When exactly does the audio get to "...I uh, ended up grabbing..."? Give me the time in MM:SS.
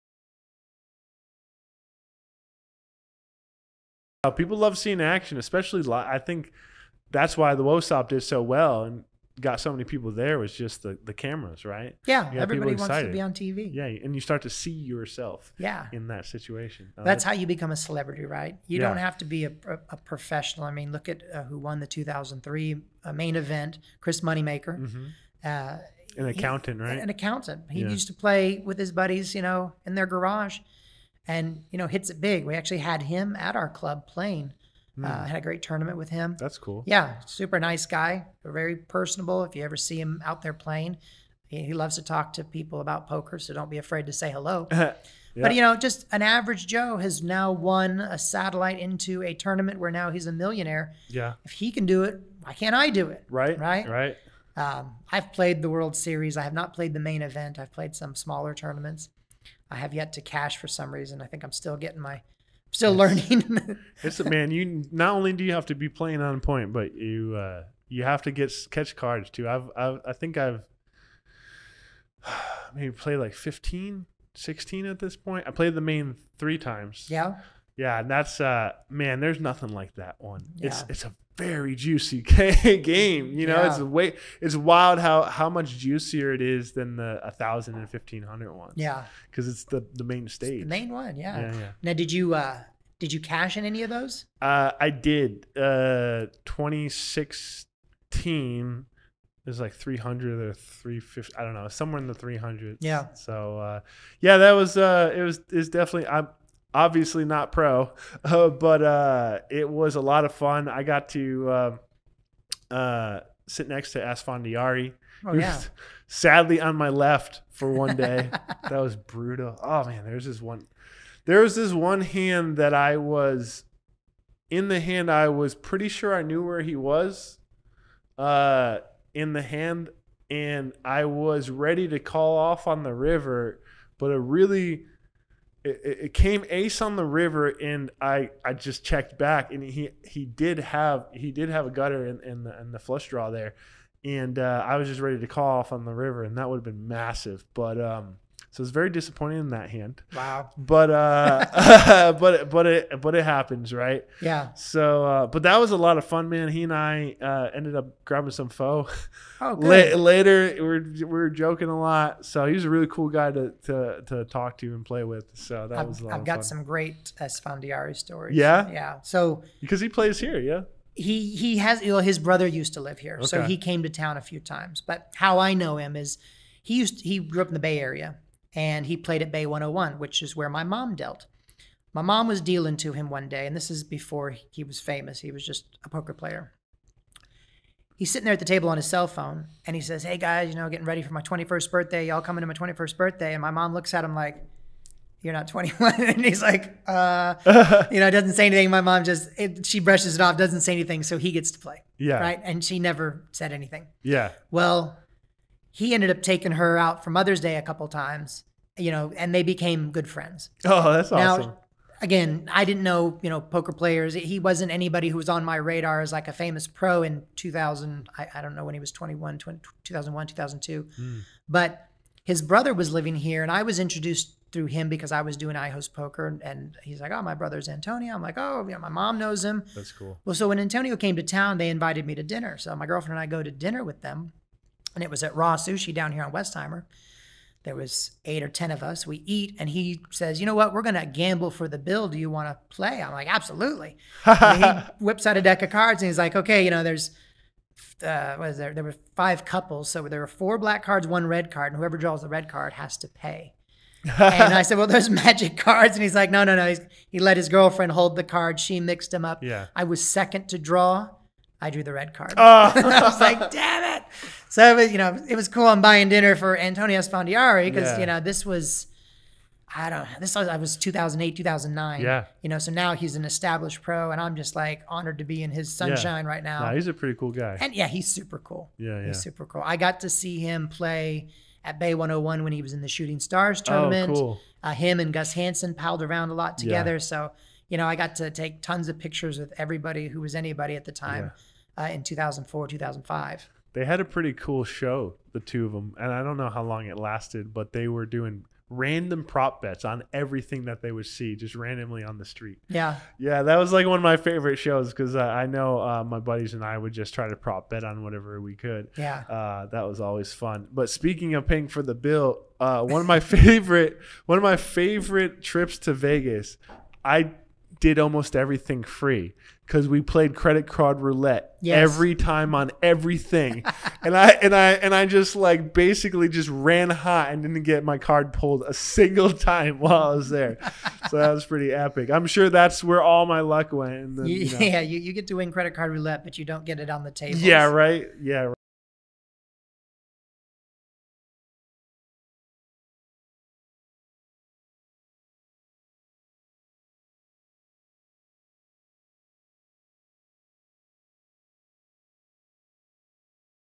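02:36.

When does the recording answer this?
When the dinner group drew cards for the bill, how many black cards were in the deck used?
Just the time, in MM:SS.
04:10.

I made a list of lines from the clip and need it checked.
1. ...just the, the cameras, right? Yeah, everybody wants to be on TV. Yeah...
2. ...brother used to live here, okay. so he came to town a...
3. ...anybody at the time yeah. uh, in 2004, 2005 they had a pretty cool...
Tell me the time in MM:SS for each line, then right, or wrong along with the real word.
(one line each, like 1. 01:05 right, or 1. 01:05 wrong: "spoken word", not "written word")
1. 00:10 right
2. 02:52 right
3. 04:50 right.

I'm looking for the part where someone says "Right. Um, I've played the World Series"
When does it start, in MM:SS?
00:53.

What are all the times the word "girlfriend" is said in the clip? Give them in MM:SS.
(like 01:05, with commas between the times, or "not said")
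03:52, 04:17.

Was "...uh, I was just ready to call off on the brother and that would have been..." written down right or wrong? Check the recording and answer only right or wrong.
wrong.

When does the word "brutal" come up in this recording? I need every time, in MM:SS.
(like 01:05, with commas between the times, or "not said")
01:58.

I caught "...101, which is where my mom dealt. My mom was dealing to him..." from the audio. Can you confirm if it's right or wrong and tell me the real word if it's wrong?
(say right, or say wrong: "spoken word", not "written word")
right.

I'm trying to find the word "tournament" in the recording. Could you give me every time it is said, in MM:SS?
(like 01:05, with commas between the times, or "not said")
00:35, 00:49, 00:58, 04:43.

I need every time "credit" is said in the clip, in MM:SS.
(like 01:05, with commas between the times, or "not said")
05:20, 05:35.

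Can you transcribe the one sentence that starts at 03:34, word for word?
He wasn't anybody who was on my radar as like a famous pro in 2000.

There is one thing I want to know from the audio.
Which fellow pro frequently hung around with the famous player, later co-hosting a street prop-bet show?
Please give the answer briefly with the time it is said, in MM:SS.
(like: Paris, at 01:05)
Gus Hansen, at 04:45.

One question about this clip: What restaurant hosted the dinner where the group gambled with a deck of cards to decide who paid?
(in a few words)
RA Sushi.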